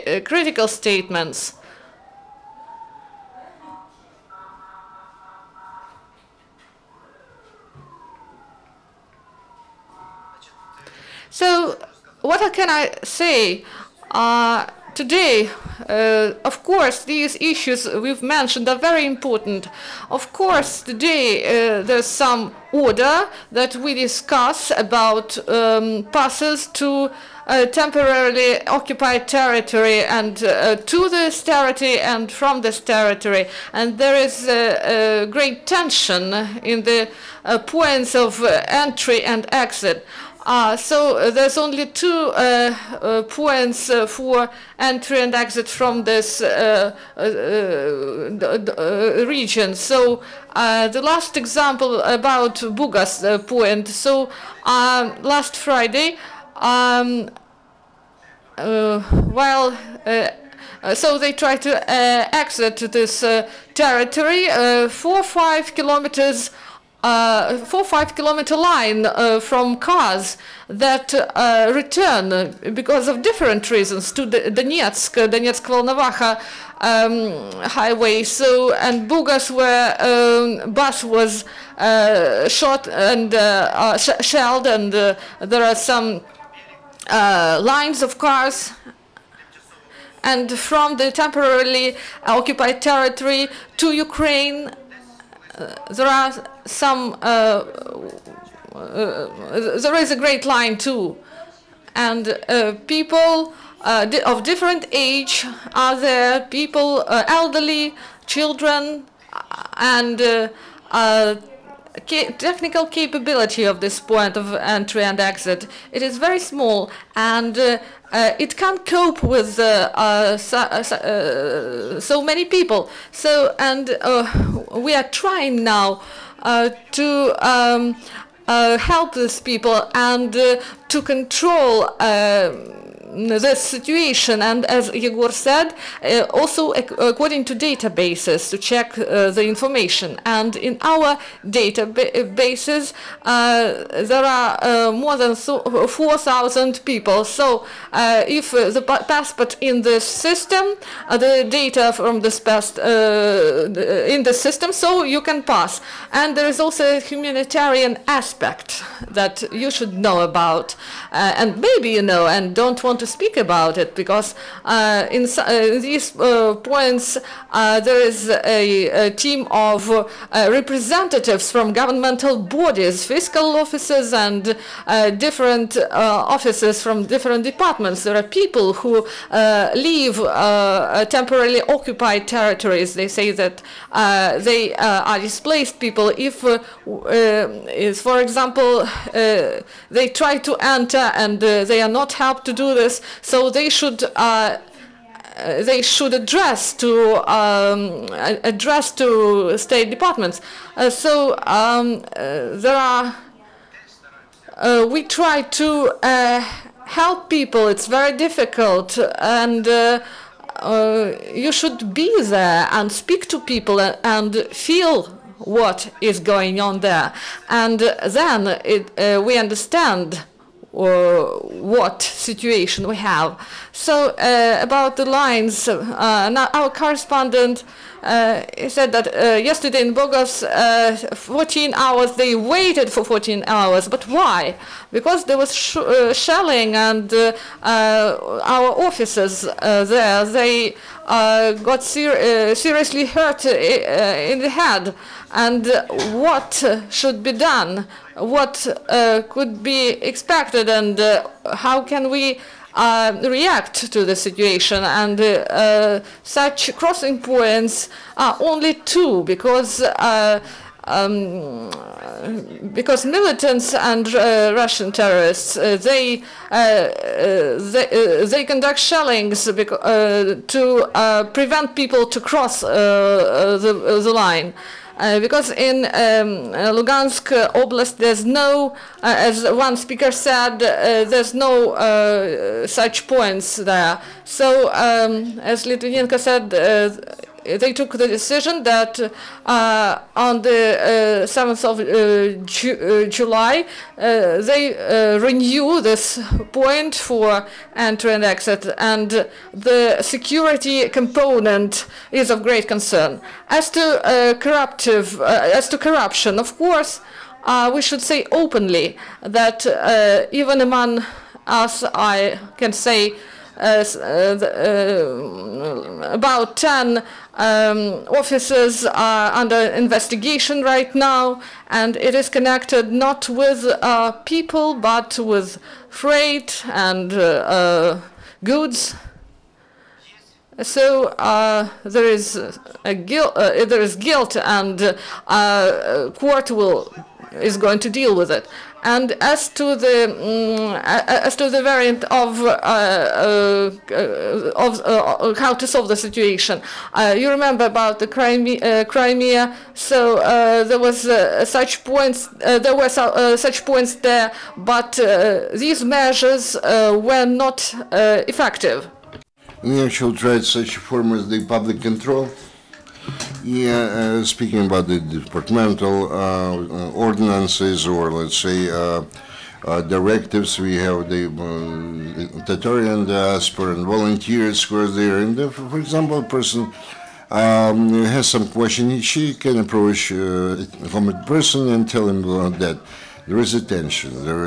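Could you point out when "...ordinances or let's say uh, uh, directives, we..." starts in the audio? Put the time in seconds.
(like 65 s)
366 s.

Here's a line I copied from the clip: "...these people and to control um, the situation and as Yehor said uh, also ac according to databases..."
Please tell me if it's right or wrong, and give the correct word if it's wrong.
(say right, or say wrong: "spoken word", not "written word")
right.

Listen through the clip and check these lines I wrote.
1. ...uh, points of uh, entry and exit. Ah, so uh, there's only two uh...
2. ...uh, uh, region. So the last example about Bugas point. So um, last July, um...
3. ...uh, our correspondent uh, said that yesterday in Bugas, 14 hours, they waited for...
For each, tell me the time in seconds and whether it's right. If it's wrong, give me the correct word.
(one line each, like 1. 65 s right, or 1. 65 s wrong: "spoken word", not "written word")
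1. 37 s right
2. 46 s wrong: "Friday", not "July"
3. 225 s right.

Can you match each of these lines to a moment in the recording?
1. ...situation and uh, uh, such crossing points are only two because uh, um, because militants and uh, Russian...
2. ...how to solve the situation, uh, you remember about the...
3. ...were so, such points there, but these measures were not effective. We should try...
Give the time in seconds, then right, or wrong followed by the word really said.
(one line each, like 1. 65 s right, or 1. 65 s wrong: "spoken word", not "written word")
1. 254 s right
2. 345 s right
3. 352 s right.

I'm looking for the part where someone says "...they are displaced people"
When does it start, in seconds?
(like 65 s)
184 s.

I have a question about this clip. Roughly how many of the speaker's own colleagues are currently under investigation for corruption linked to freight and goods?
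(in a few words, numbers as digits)
10.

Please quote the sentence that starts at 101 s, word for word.
And people of different age are there, people, elderly, children, and technical capability of this point of entry and exit.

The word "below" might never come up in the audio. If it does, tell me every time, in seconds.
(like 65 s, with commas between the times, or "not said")
not said.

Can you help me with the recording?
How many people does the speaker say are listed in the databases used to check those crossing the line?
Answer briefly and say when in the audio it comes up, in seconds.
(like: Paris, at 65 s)
more than 4,000, at 144 s.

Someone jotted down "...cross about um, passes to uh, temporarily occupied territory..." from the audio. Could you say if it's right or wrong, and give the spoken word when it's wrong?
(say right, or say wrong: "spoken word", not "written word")
wrong: "discuss", not "cross".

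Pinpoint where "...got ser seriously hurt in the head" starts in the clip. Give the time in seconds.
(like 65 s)
241 s.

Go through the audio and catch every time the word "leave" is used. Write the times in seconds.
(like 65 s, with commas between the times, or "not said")
179 s.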